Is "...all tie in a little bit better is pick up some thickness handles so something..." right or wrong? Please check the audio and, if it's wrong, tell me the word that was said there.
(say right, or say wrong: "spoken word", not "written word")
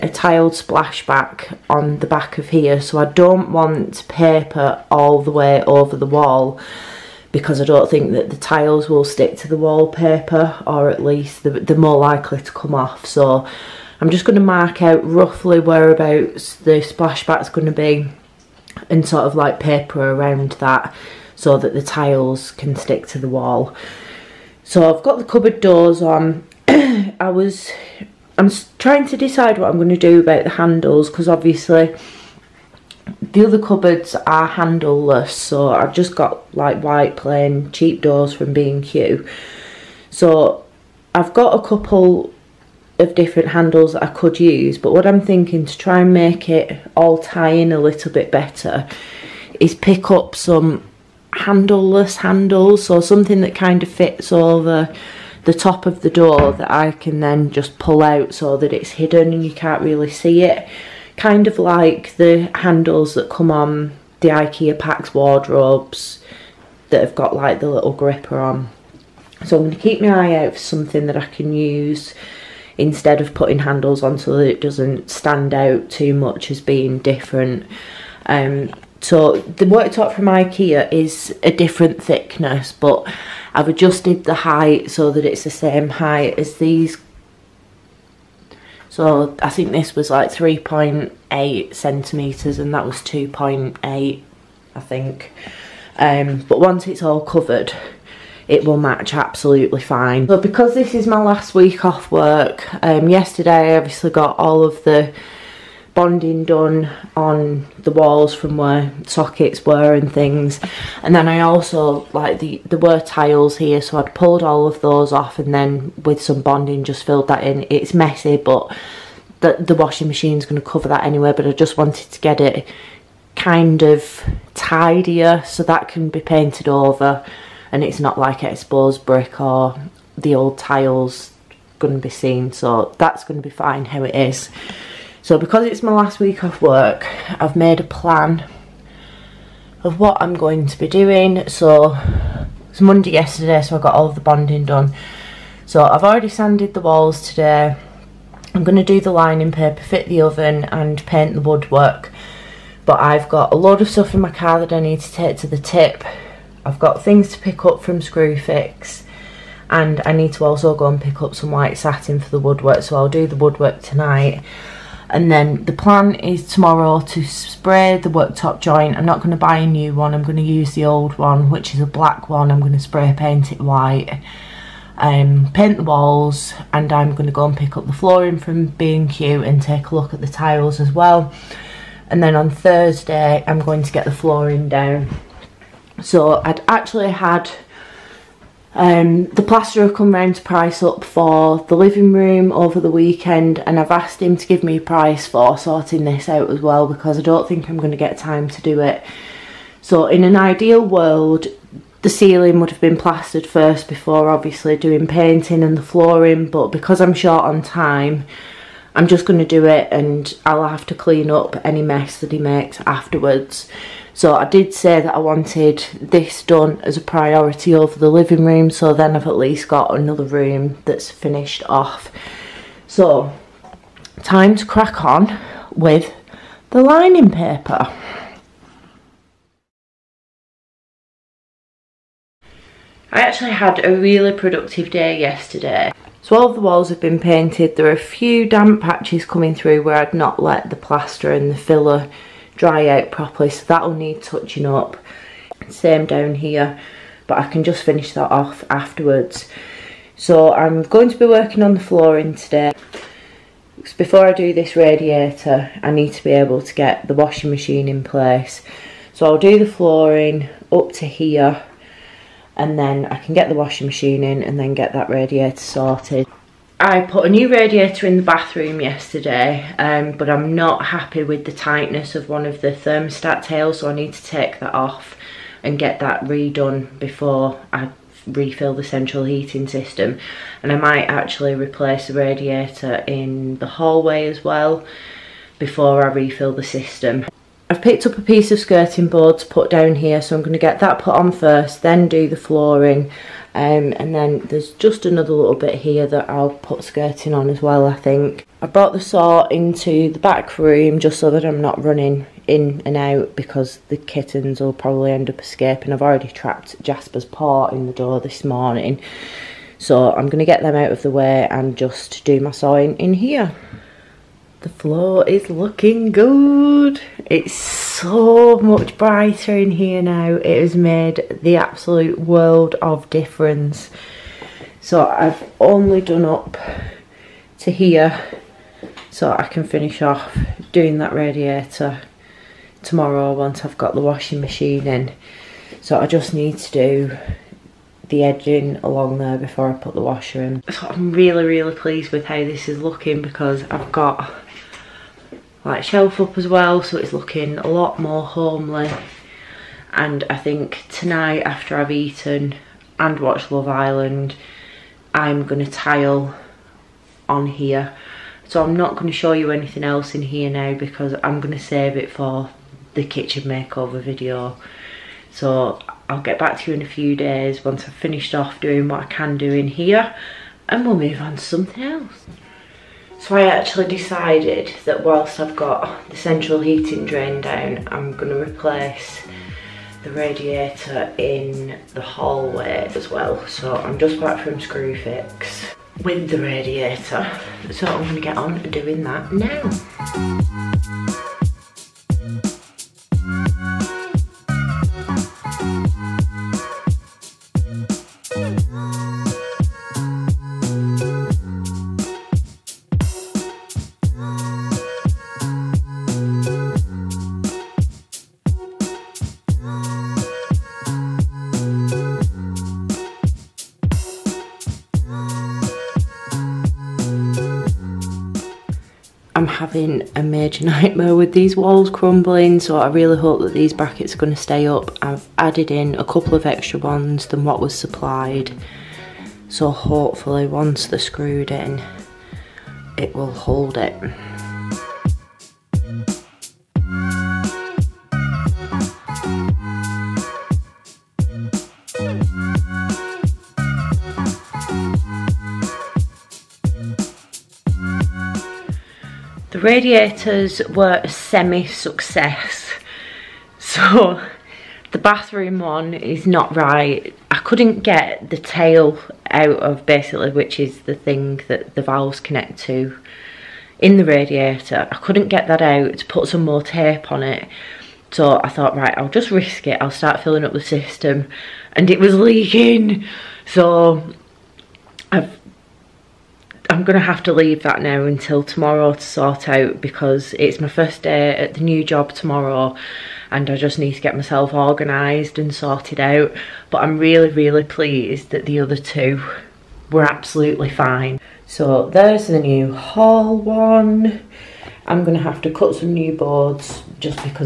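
wrong: "handleless", not "thickness".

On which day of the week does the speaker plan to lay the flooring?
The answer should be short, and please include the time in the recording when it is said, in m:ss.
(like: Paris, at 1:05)
Thursday, at 3:02.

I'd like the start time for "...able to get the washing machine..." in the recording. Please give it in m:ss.
4:16.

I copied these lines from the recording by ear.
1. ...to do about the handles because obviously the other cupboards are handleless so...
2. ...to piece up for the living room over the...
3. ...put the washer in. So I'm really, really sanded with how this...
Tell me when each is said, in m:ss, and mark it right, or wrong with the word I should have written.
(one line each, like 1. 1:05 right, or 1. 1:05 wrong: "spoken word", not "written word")
1. 0:29 right
2. 3:10 wrong: "price", not "piece"
3. 5:39 wrong: "pleased", not "sanded".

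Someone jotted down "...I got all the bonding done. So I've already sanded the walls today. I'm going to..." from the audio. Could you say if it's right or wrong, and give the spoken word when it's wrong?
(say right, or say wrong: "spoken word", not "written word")
right.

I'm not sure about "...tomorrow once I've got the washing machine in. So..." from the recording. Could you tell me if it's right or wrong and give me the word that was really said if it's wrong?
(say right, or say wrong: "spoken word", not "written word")
right.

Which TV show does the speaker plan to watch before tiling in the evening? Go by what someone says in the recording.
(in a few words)
Love Island.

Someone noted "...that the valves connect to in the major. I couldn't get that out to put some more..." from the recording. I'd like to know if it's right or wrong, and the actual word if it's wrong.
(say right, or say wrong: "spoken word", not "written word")
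wrong: "radiator", not "major".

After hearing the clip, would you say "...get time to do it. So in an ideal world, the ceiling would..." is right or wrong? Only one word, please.
right.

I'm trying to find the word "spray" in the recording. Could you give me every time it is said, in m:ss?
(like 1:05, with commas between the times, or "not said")
2:47, 2:52.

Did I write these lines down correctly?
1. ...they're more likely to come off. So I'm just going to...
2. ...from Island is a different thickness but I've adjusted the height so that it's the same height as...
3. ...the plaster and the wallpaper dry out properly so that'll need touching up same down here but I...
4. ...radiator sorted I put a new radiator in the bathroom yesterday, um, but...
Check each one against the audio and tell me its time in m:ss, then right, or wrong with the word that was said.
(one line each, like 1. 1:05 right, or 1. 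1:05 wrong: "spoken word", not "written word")
1. 0:11 right
2. 1:20 wrong: "IKEA", not "Island"
3. 4:00 wrong: "filler", not "wallpaper"
4. 4:25 right.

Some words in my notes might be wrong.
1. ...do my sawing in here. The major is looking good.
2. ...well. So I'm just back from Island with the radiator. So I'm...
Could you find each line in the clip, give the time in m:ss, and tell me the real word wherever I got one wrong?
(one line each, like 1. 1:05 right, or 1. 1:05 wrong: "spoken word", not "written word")
1. 5:12 wrong: "floor", not "major"
2. 6:23 wrong: "Screwfix", not "Island".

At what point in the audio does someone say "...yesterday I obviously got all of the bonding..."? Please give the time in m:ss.
1:43.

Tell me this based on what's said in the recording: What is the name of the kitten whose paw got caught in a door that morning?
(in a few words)
Jasper.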